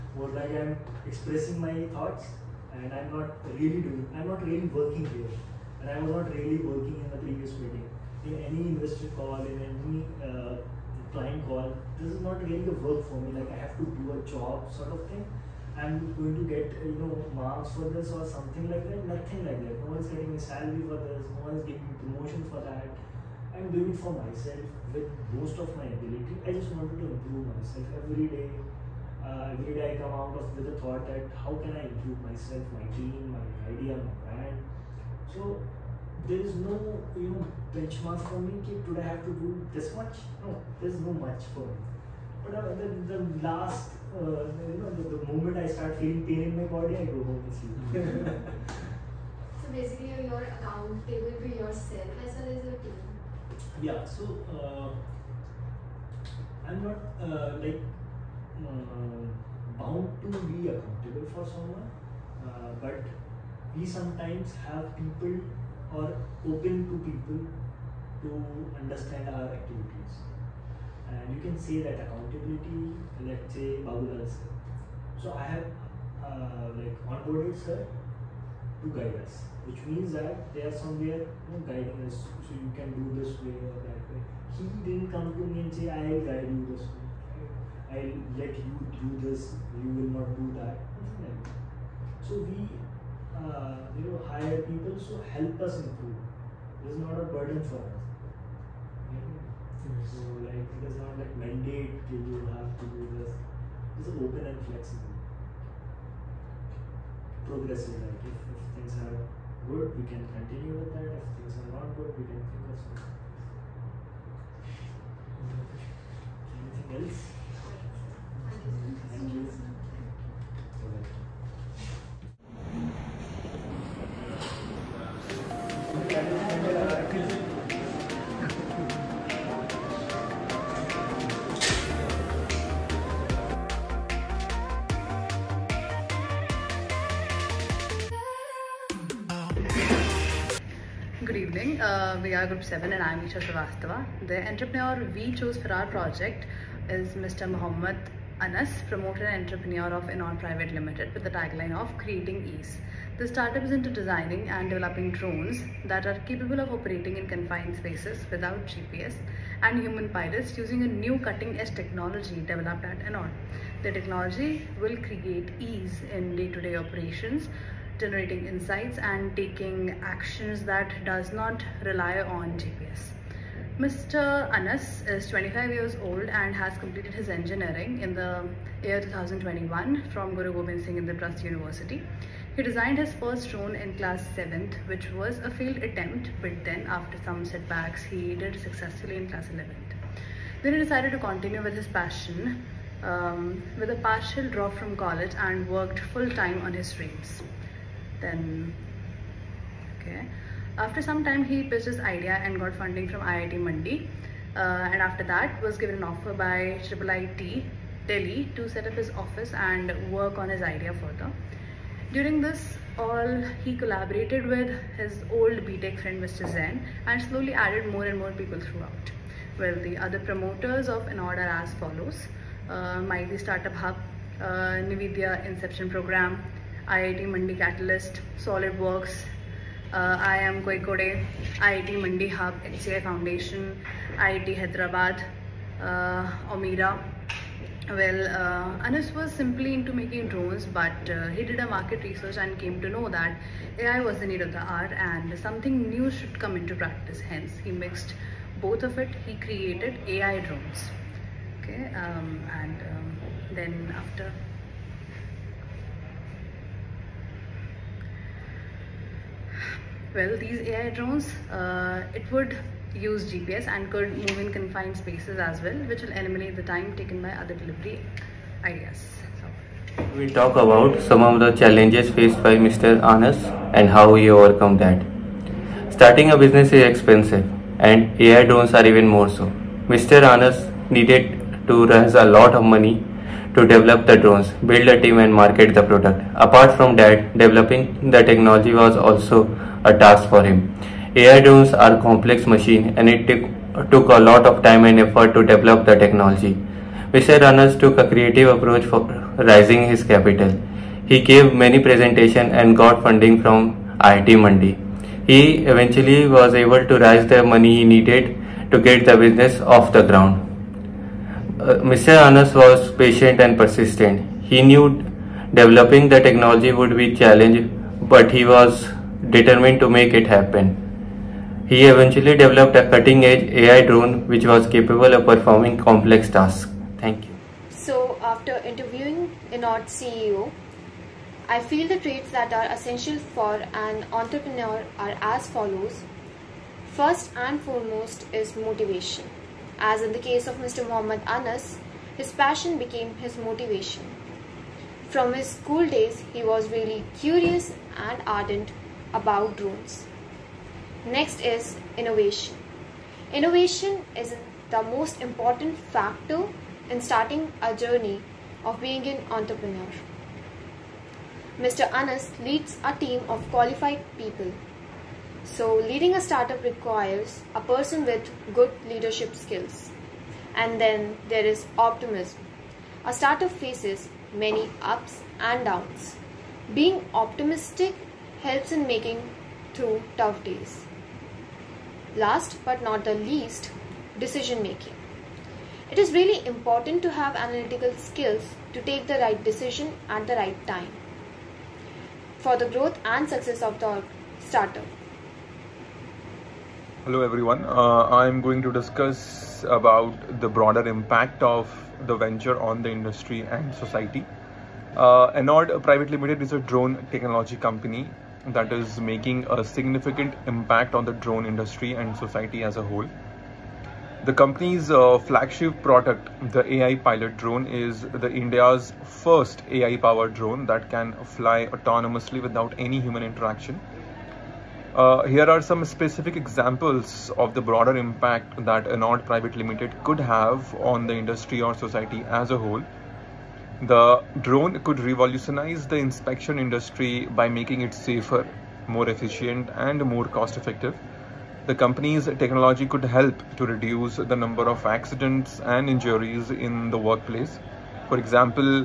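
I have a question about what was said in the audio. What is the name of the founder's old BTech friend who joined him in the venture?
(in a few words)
Zen.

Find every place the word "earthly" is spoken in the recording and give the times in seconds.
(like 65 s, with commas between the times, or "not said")
not said.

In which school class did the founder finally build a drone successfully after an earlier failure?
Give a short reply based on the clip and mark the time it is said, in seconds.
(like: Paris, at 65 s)
Class 11, at 189 s.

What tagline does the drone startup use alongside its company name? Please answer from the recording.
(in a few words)
Creating Ease.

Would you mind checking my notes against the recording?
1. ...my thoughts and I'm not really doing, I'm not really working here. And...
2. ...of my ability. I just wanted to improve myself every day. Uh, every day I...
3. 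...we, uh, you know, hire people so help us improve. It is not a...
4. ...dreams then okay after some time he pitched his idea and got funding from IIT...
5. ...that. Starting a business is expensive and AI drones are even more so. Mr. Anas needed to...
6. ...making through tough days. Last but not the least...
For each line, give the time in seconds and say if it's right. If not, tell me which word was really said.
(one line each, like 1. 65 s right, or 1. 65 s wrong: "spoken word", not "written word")
1. 1 s right
2. 25 s right
3. 92 s right
4. 196 s right
5. 274 s right
6. 378 s right.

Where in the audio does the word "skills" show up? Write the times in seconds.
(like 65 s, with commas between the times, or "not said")
369 s, 388 s.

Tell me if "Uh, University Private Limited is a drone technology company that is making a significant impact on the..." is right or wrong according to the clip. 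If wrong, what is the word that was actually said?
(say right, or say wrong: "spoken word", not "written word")
wrong: "Enord", not "University".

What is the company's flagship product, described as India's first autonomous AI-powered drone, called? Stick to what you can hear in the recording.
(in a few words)
AI Pilot drone.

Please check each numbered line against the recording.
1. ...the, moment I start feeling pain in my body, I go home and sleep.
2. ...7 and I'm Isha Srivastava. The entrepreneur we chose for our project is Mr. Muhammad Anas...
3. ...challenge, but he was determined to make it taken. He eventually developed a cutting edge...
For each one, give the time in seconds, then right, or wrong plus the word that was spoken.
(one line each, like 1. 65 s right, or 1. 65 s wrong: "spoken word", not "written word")
1. 45 s right
2. 142 s right
3. 317 s wrong: "happen", not "taken".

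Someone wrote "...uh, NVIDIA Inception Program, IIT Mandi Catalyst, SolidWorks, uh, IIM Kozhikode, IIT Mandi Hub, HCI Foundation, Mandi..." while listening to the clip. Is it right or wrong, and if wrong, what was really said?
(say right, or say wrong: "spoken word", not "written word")
wrong: "IIT", not "Mandi".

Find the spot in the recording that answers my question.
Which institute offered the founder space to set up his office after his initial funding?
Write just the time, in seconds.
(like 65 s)
206 s.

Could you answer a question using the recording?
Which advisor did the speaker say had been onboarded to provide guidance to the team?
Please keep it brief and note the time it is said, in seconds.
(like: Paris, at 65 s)
Babulal, at 73 s.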